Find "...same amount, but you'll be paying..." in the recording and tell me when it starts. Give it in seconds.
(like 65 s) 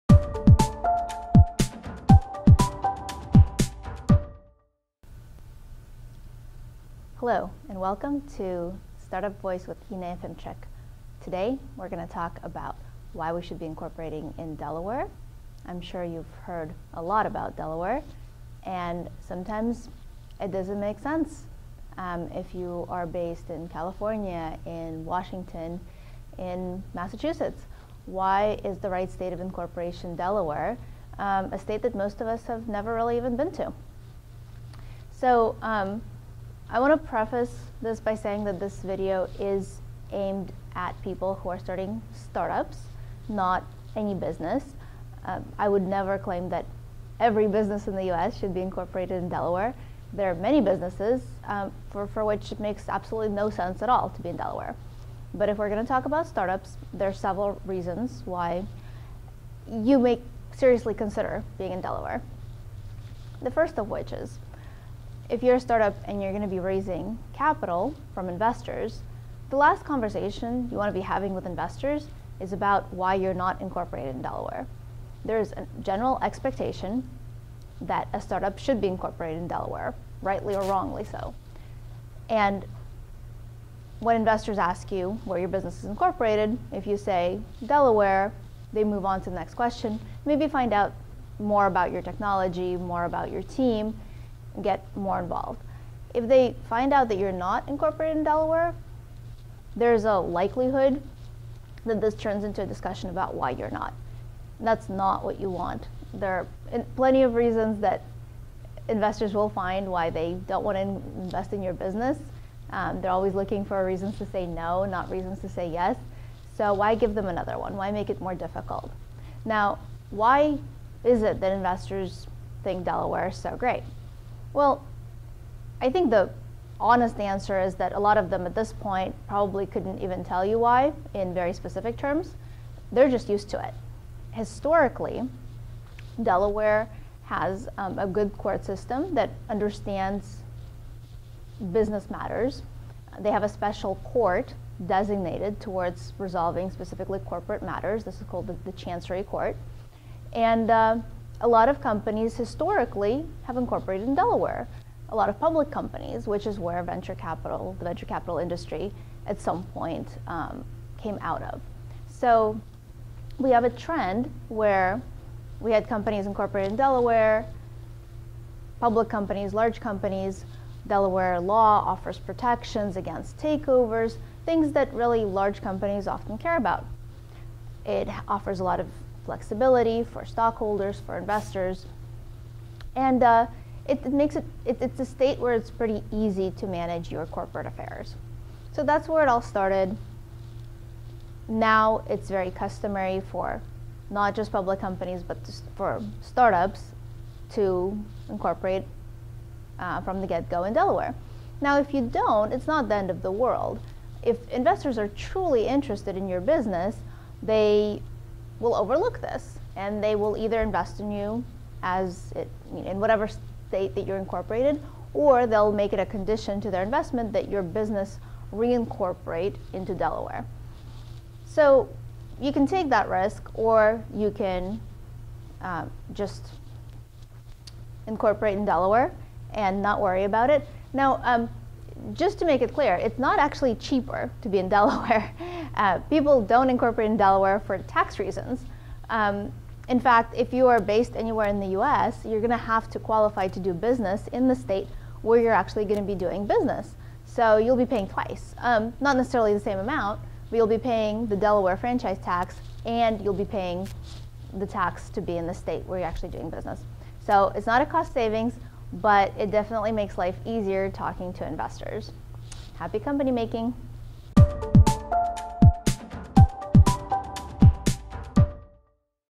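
249 s.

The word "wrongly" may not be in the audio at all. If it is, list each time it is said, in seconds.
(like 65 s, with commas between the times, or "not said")
80 s.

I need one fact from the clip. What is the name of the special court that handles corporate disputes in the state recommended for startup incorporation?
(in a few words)
Chancery Court.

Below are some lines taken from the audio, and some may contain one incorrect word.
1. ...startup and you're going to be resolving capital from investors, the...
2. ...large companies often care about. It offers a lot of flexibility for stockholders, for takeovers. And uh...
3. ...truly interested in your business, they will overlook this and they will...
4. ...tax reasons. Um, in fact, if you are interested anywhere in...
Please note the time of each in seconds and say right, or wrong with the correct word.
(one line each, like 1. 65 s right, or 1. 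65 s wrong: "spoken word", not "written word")
1. 65 s wrong: "raising", not "resolving"
2. 175 s wrong: "investors", not "takeovers"
3. 205 s right
4. 237 s wrong: "based", not "interested".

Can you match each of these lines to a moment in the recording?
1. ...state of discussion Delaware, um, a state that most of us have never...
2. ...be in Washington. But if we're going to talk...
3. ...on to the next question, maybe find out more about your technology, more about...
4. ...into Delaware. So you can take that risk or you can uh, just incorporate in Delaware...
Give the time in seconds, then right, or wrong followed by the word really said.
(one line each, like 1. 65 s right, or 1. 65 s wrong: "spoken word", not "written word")
1. 29 s wrong: "incorporation", not "discussion"
2. 54 s wrong: "Delaware", not "Washington"
3. 89 s right
4. 219 s right.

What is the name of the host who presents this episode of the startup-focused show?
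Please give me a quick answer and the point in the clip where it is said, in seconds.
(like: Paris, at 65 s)
Inna Efimchik, at 9 s.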